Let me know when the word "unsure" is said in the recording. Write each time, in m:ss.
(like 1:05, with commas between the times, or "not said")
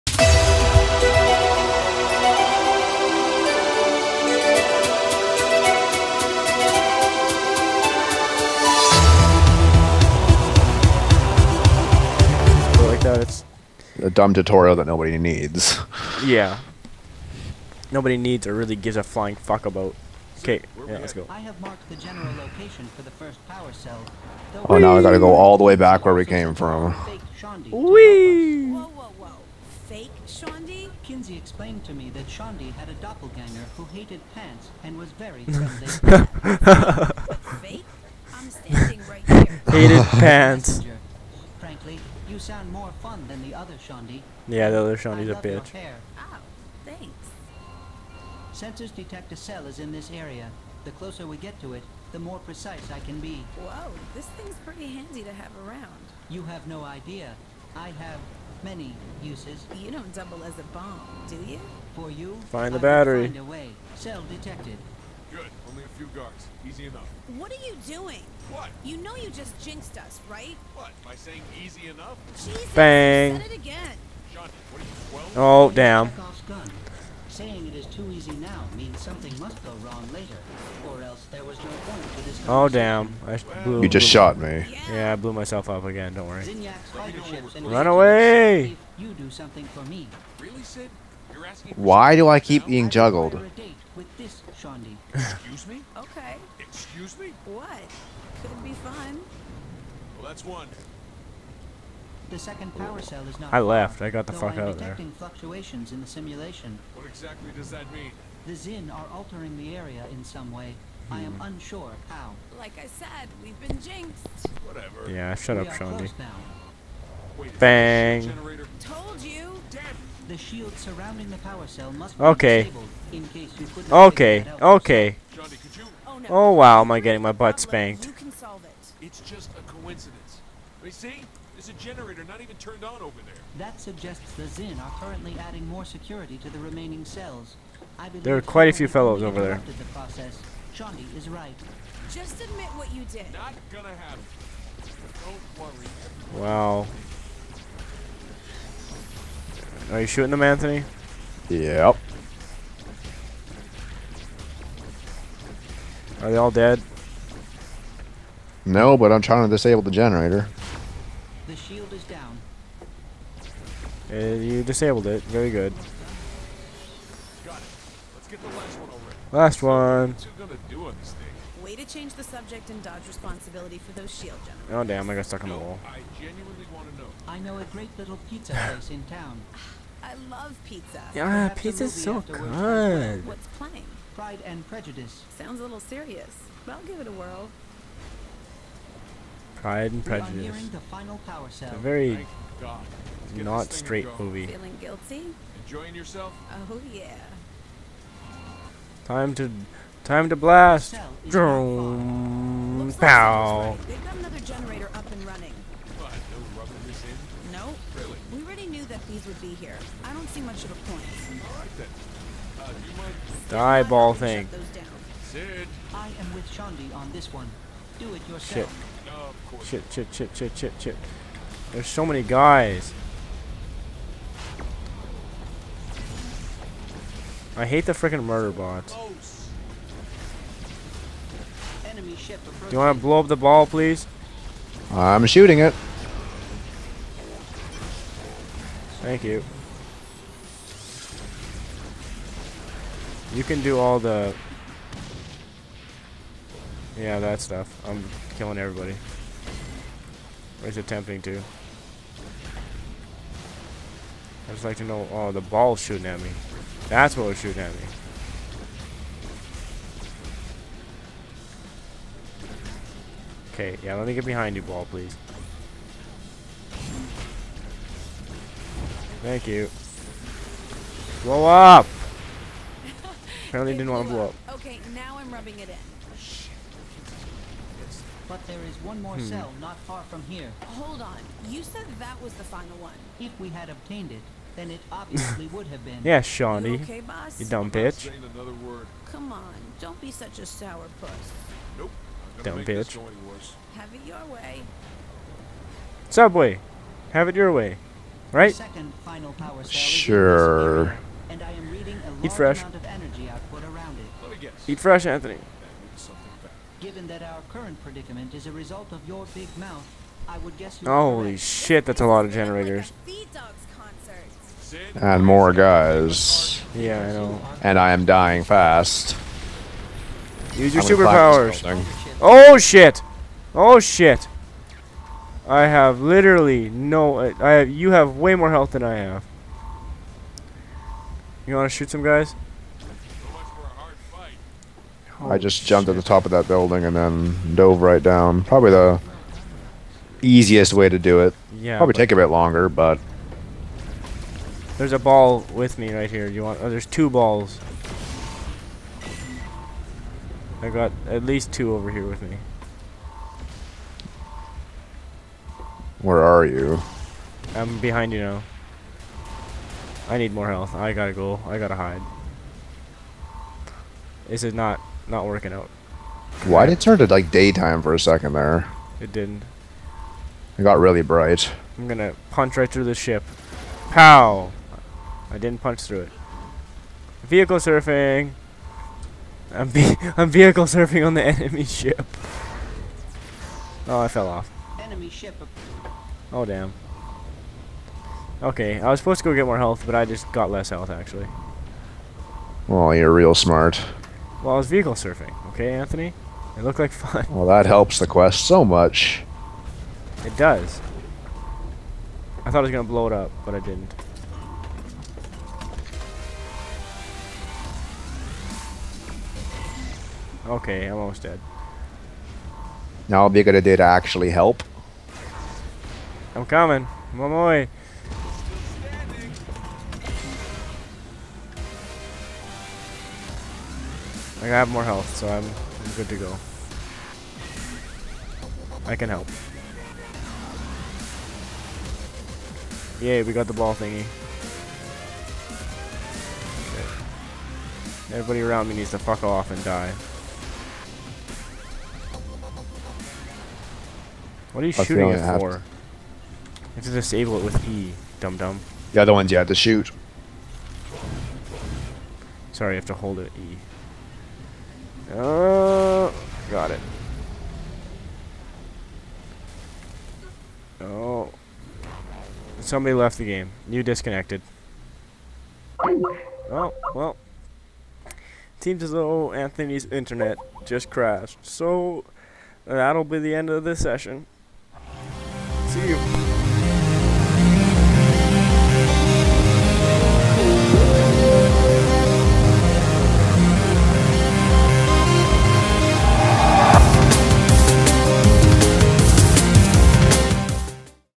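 1:51.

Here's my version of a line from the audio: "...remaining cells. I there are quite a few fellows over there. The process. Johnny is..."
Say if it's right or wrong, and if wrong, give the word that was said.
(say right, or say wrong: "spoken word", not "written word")
right.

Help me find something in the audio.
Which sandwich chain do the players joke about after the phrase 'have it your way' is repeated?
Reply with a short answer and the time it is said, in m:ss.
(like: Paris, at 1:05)
Subway, at 4:56.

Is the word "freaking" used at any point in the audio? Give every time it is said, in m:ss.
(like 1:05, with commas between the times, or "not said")
3:47.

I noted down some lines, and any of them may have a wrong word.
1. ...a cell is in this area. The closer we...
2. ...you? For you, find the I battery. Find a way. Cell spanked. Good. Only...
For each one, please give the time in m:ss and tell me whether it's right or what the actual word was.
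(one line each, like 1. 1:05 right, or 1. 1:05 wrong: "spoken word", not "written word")
1. 0:49 right
2. 1:01 wrong: "detected", not "spanked".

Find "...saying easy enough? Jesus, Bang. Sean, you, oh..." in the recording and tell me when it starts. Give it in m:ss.
1:11.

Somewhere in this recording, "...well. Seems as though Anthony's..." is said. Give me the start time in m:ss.
7:46.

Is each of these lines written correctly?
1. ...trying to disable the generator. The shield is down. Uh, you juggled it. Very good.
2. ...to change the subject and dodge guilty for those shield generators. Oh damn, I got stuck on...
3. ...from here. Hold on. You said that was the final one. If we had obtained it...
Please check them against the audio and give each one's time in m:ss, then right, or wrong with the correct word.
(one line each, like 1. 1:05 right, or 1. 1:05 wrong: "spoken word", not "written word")
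1. 2:39 wrong: "disabled", not "juggled"
2. 2:51 wrong: "responsibility", not "guilty"
3. 4:40 right.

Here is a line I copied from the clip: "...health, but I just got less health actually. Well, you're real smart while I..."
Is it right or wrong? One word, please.
right.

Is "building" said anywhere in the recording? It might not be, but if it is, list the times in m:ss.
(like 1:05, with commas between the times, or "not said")
5:36.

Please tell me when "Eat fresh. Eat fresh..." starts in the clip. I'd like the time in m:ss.
5:02.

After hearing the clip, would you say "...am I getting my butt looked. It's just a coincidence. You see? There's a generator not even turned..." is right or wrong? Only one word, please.
wrong.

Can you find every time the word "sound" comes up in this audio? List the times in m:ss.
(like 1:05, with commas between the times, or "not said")
0:42, 3:05.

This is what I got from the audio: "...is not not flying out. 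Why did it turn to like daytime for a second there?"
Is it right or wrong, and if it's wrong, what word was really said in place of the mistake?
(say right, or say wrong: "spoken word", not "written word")
wrong: "working", not "flying".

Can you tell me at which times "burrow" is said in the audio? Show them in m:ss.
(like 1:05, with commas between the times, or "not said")
not said.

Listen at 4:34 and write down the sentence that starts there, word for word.
Okay, now I'm rubbing it in.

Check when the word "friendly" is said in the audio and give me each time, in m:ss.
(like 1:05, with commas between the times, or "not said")
0:35.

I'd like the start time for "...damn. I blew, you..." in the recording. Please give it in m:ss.
1:22.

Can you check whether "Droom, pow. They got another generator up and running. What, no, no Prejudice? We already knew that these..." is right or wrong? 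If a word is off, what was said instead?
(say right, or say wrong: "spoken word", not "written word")
wrong: "Really", not "Prejudice".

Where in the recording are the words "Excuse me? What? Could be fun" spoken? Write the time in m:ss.
1:36.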